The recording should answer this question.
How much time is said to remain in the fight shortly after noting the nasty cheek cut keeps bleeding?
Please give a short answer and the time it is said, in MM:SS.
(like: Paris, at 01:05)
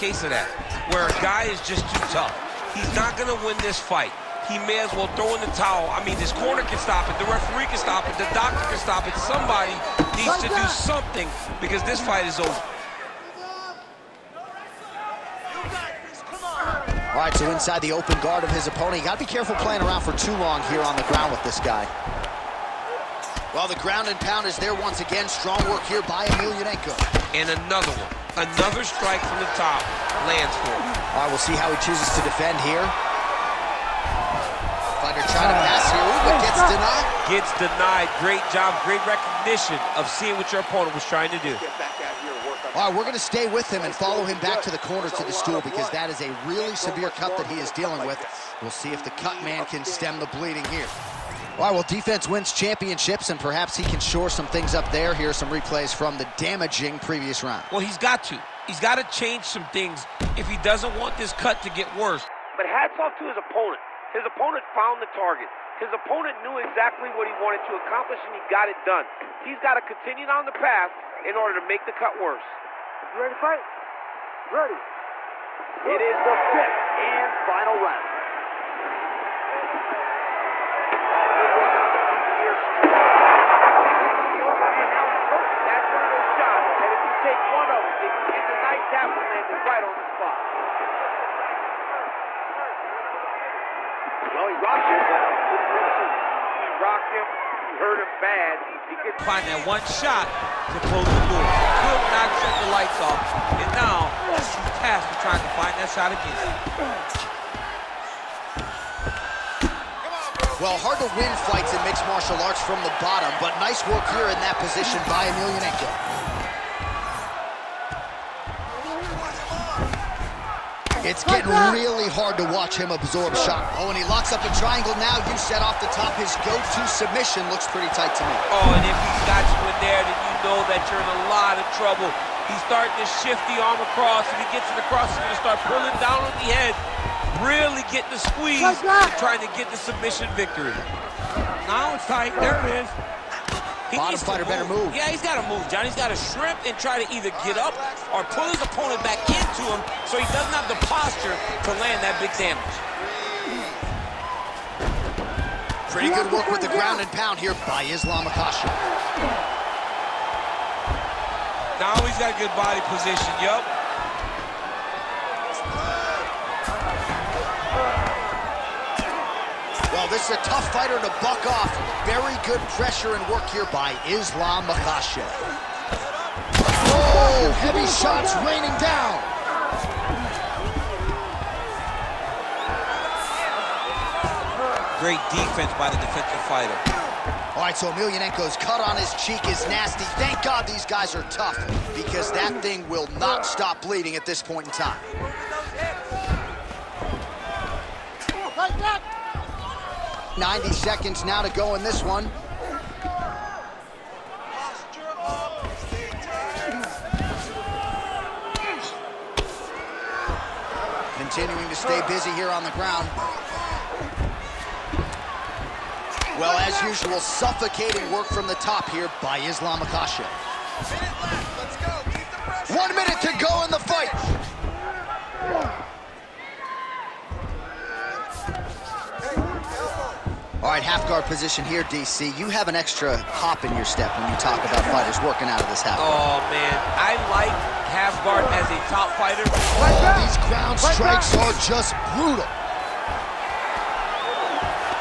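90 seconds, at 03:20.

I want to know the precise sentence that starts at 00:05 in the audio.
I mean, this corner can stop it, the referee can stop it, the doctor can stop it.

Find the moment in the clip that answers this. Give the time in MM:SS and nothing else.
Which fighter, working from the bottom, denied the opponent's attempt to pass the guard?
00:35.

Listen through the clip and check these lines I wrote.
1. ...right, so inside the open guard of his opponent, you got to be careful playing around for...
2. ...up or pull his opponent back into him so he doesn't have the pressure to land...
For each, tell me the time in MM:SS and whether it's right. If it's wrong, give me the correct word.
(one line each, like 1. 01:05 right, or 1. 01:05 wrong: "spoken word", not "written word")
1. 00:17 right
2. 02:27 wrong: "posture", not "pressure".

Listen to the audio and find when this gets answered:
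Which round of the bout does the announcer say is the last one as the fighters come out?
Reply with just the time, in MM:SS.
01:16.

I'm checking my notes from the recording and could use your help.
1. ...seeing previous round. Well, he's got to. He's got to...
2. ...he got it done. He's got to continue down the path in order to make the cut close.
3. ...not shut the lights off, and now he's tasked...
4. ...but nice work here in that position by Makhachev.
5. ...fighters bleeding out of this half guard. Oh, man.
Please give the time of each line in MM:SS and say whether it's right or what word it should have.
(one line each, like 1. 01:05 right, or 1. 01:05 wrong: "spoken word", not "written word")
1. 00:56 wrong: "damaging", not "seeing"
2. 01:08 wrong: "worse", not "close"
3. 01:42 right
4. 01:53 wrong: "Emelianenko", not "Makhachev"
5. 03:54 wrong: "working", not "bleeding".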